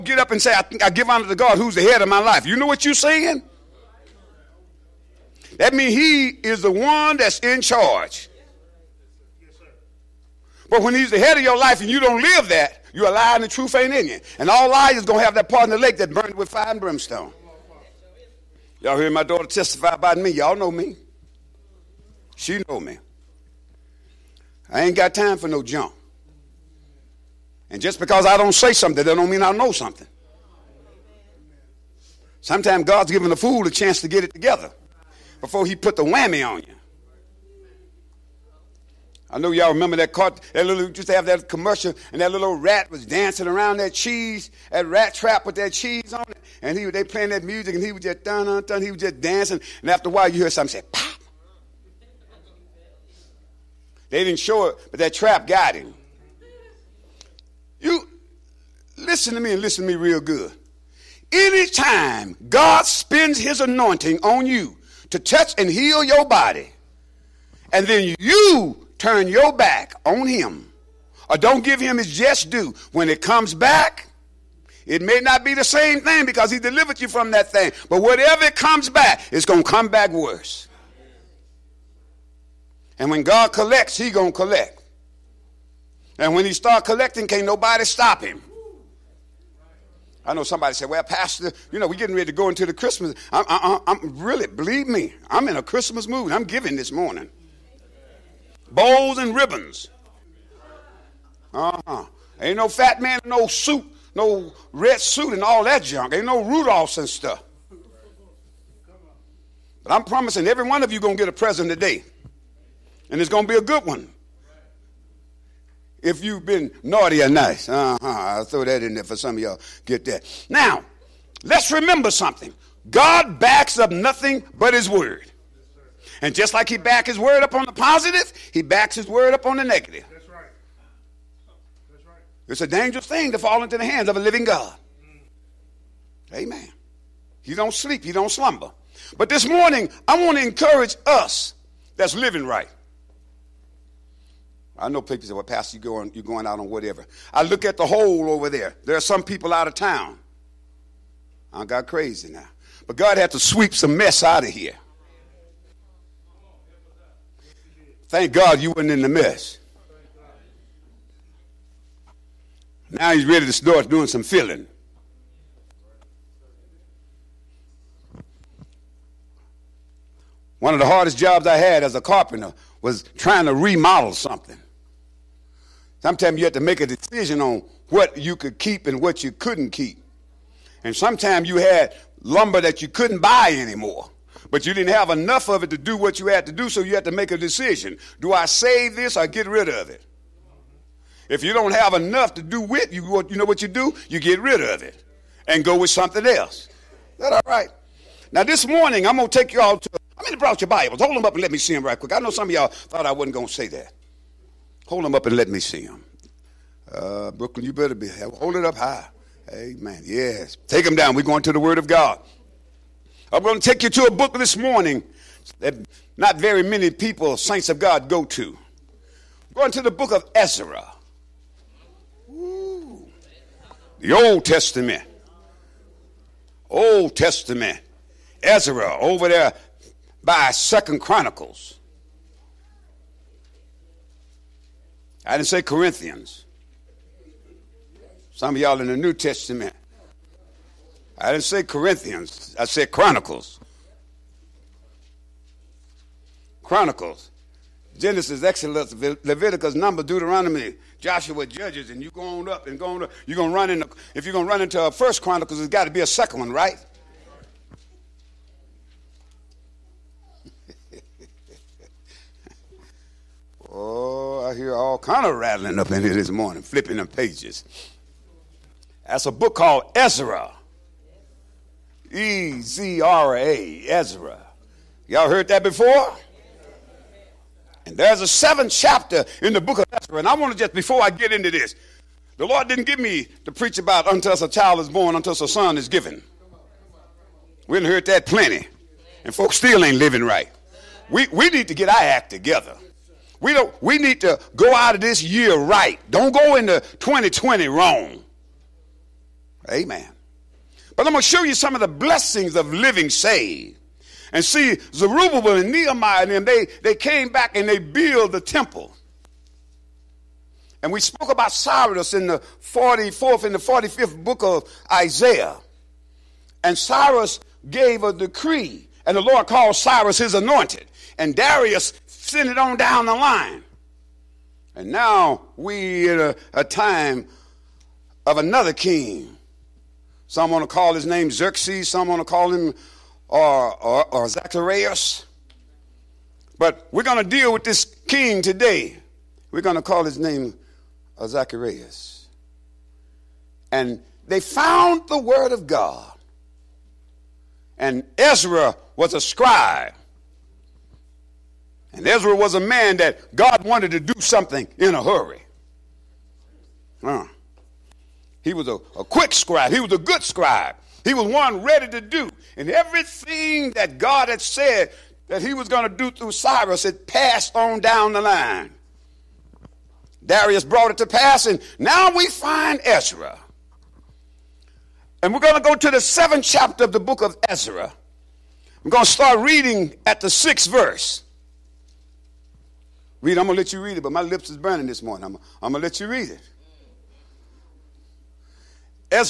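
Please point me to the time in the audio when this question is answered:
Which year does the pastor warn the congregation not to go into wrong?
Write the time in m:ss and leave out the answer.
4:56.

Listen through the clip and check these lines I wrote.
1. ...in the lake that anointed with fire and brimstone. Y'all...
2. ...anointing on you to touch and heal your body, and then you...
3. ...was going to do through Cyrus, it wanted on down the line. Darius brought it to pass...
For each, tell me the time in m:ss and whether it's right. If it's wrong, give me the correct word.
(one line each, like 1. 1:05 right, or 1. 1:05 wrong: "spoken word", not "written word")
1. 0:15 wrong: "burned", not "anointed"
2. 1:03 right
3. 6:05 wrong: "passed", not "wanted".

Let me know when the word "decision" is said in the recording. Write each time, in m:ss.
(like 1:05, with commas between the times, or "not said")
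2:56, 3:07.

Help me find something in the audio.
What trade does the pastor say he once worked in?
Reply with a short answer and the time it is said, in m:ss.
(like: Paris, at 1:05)
Carpenter, at 2:52.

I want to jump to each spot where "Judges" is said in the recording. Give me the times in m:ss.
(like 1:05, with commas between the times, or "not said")
4:11.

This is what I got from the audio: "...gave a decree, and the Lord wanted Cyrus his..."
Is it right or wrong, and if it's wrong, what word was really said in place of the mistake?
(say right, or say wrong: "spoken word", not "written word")
wrong: "called", not "wanted".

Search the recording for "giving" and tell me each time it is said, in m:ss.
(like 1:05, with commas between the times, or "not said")
0:33, 1:36.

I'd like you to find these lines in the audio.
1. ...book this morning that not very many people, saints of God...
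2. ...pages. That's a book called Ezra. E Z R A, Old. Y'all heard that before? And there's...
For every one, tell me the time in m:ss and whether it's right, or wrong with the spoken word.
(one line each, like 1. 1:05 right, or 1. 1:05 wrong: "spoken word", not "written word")
1. 3:34 right
2. 4:27 wrong: "Ezra", not "Old".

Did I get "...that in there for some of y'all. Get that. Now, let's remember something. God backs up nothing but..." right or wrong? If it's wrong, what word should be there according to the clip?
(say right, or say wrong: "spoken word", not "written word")
right.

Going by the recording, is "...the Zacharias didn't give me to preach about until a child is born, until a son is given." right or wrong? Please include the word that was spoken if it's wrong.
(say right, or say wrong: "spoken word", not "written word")
wrong: "Lord", not "Zacharias".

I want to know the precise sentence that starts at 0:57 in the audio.
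You, listen to me and listen to me real good.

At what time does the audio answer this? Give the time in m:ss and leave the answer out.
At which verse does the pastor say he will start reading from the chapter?
6:20.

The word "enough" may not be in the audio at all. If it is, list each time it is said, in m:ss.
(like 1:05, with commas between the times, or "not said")
3:05, 3:11.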